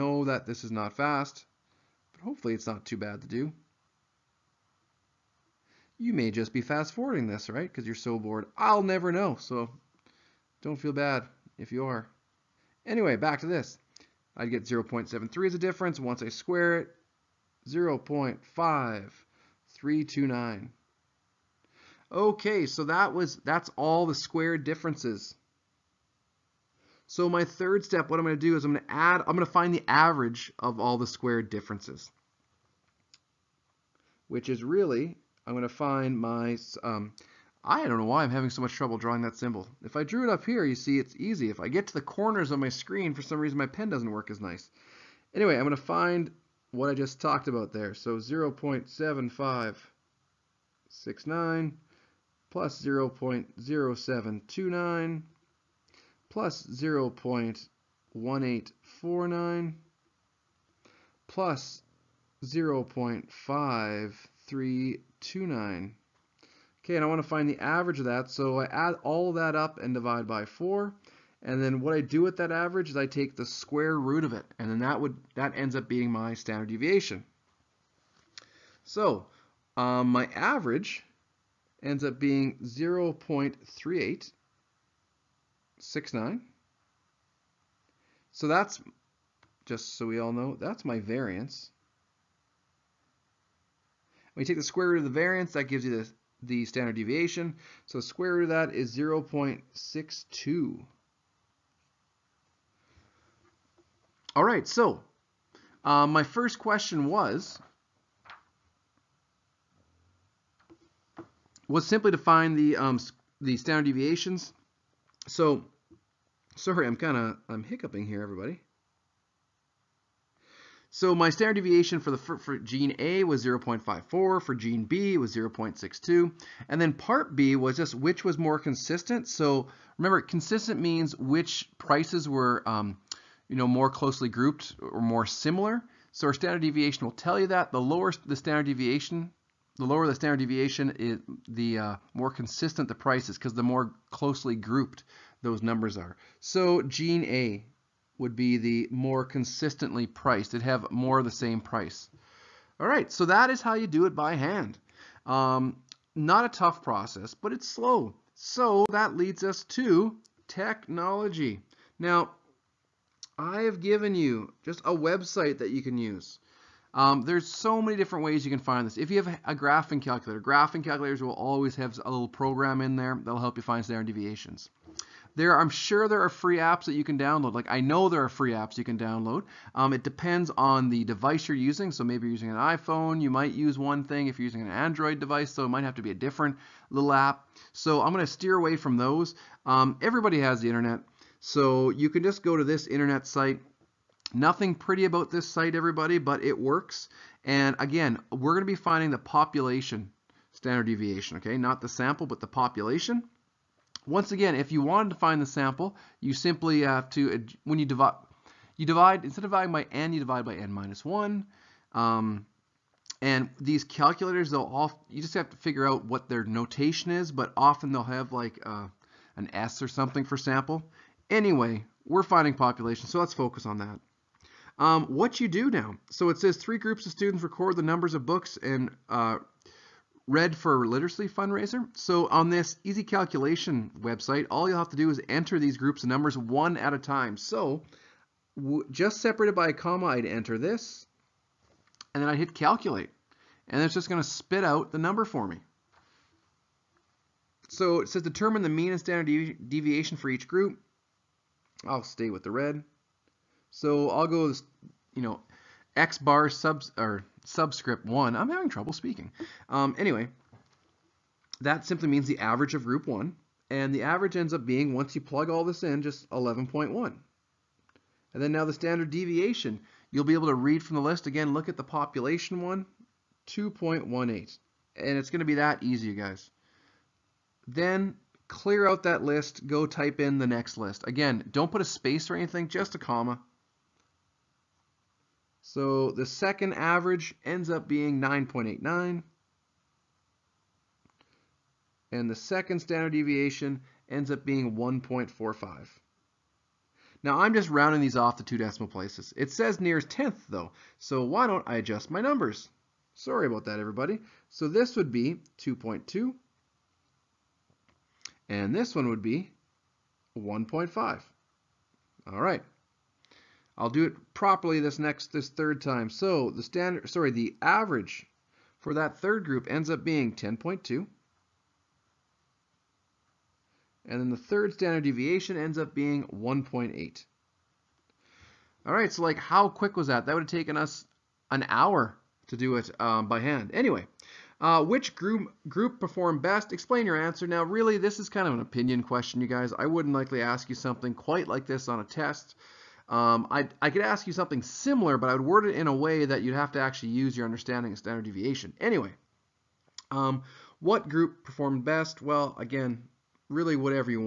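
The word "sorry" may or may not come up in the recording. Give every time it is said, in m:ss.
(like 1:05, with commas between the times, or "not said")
1:56, 5:03, 5:17.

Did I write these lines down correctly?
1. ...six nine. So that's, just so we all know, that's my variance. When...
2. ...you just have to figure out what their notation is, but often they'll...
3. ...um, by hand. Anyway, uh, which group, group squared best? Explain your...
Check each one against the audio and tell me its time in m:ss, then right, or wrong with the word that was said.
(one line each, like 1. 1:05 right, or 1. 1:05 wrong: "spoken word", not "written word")
1. 1:25 right
2. 3:35 right
3. 5:32 wrong: "performed", not "squared".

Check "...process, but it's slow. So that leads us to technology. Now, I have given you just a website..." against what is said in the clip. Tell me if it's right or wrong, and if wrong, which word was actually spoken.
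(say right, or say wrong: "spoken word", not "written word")
right.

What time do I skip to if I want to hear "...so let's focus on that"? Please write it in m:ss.
3:43.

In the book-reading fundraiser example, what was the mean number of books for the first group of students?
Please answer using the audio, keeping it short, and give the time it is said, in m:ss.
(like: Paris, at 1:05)
11.1, at 4:26.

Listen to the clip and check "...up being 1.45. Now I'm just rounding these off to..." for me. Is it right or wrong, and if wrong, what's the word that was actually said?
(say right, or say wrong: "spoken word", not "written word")
right.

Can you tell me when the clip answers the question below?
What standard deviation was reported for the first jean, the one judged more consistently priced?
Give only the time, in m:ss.
2:03.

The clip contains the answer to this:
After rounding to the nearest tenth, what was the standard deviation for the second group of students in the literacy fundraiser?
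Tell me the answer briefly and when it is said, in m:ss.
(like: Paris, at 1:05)
1.5, at 5:10.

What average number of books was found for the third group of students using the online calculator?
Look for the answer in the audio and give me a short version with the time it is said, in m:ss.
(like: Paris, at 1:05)
10.2, at 5:20.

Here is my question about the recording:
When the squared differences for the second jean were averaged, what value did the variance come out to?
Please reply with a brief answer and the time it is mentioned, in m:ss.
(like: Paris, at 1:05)
0.3869, at 1:22.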